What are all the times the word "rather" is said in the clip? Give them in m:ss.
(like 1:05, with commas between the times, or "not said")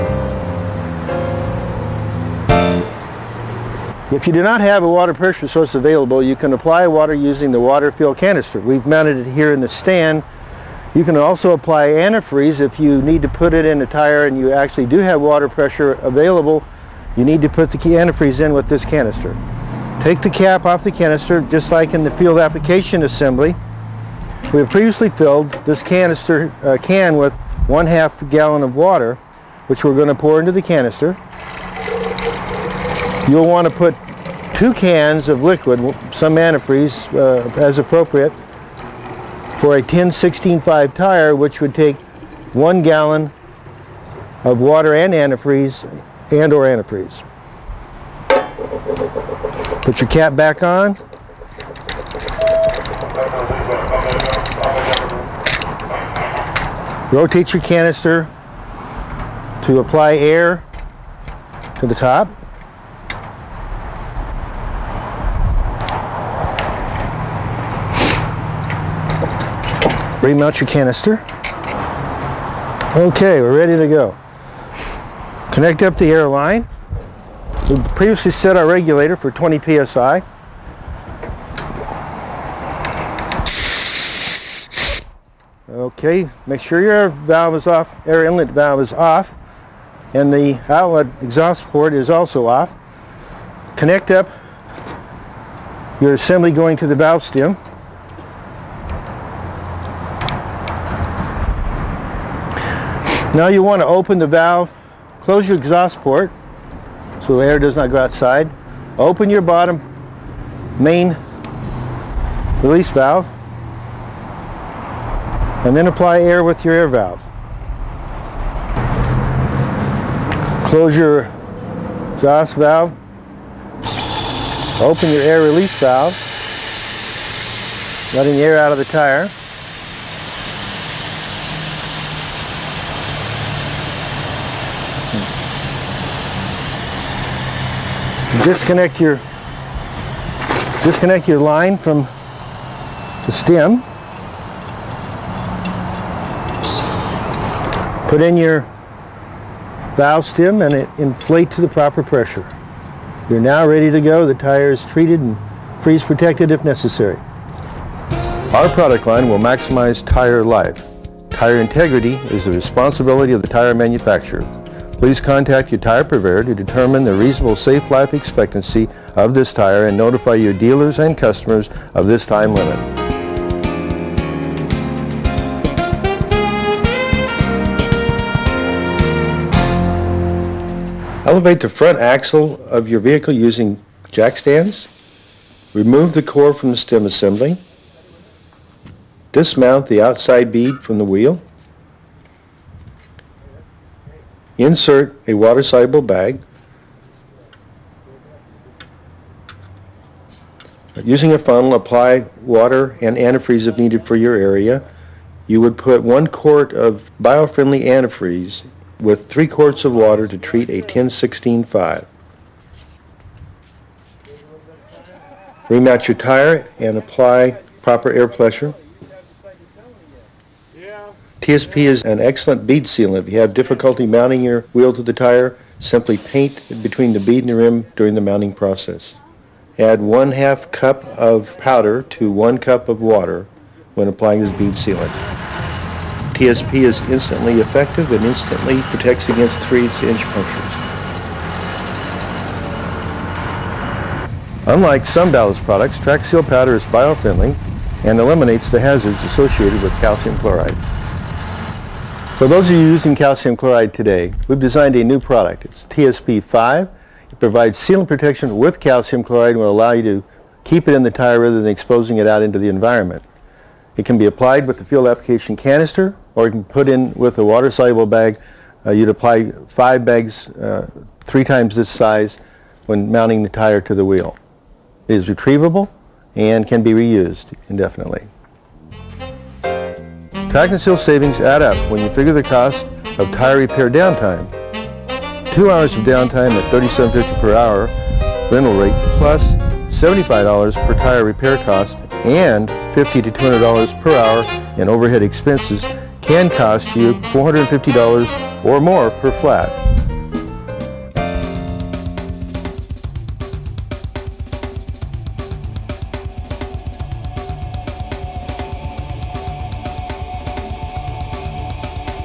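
4:21.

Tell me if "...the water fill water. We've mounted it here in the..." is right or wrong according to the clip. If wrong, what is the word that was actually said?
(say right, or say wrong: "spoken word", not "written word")
wrong: "canister", not "water".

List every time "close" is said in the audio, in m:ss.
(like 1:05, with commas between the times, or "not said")
1:45, 2:00.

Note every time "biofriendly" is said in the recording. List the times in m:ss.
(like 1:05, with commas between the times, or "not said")
3:27, 4:06.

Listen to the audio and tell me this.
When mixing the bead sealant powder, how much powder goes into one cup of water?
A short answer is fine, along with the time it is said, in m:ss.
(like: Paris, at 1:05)
1/2 cup, at 3:50.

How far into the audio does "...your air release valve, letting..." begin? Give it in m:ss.
2:05.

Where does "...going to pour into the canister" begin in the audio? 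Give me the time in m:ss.
0:29.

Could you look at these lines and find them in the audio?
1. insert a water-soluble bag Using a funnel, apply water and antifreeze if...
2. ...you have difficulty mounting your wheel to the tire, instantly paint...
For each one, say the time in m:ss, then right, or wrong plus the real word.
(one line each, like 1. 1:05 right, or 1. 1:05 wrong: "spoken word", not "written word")
1. 3:14 right
2. 3:43 wrong: "simply", not "instantly".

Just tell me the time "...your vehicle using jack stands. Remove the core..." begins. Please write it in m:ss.
3:02.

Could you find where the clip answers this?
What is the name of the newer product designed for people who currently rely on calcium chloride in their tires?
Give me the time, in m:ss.
4:15.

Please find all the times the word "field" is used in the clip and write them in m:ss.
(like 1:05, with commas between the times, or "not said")
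0:22, 4:24.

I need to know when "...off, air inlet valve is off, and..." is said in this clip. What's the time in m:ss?
1:27.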